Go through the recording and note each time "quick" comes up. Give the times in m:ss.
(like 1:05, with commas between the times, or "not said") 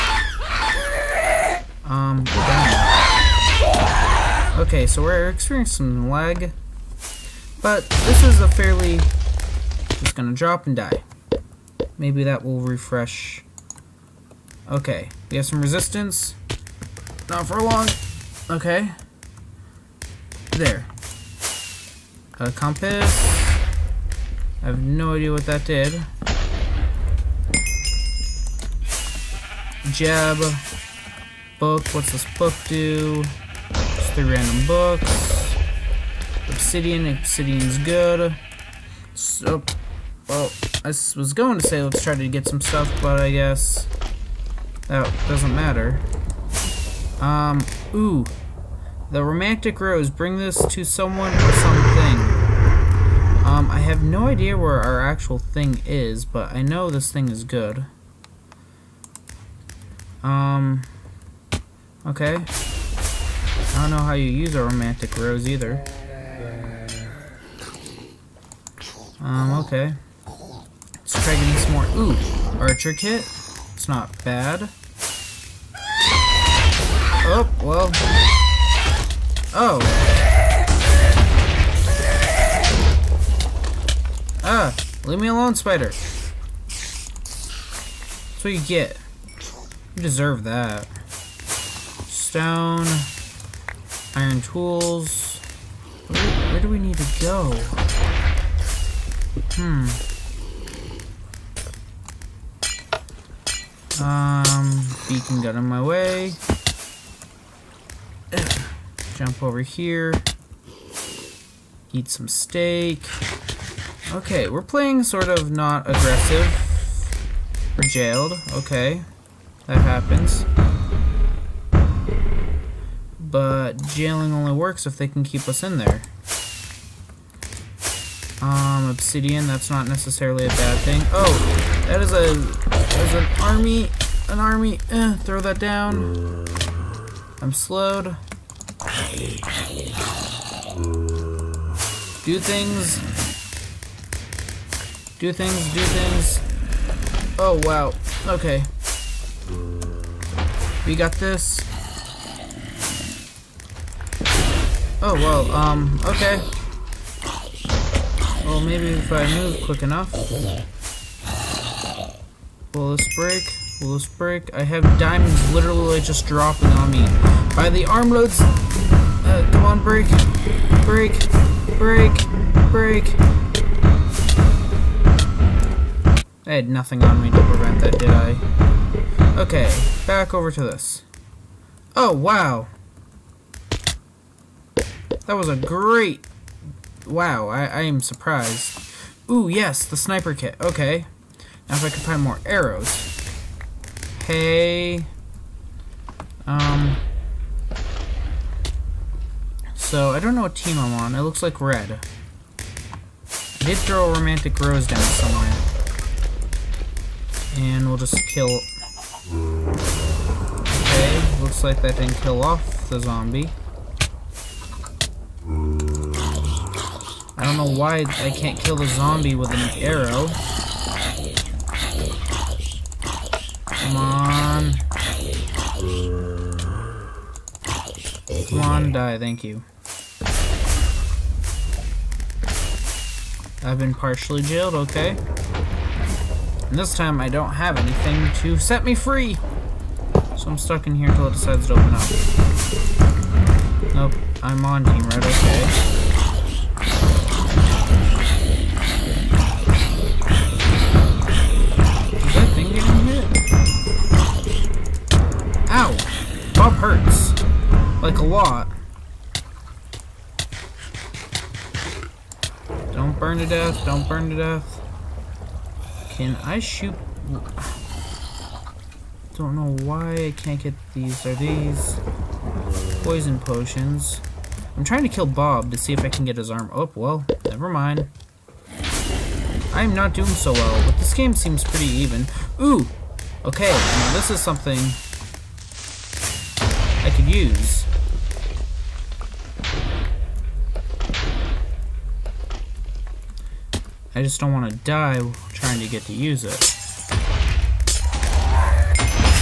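2:39.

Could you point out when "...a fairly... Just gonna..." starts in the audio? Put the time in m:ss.
0:08.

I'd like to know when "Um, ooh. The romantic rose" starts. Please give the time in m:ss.
0:47.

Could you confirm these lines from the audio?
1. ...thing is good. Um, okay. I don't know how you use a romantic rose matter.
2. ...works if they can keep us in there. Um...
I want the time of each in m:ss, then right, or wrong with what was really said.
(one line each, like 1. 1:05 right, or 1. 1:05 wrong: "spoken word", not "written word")
1. 0:57 wrong: "either", not "matter"
2. 2:04 right.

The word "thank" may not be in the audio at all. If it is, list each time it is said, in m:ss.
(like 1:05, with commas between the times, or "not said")
3:49.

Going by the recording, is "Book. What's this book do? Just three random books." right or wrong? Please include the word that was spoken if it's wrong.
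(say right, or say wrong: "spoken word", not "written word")
right.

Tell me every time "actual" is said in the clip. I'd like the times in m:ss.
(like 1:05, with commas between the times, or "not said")
0:55.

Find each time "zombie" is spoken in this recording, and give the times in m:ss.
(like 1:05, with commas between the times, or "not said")
3:32, 3:38.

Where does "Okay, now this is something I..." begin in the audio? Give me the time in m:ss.
4:43.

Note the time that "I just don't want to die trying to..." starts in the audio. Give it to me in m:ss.
4:54.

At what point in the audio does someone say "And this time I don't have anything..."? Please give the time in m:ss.
3:56.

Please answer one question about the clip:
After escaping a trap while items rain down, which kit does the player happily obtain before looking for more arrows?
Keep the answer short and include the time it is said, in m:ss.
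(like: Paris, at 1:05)
Sniper kit, at 3:09.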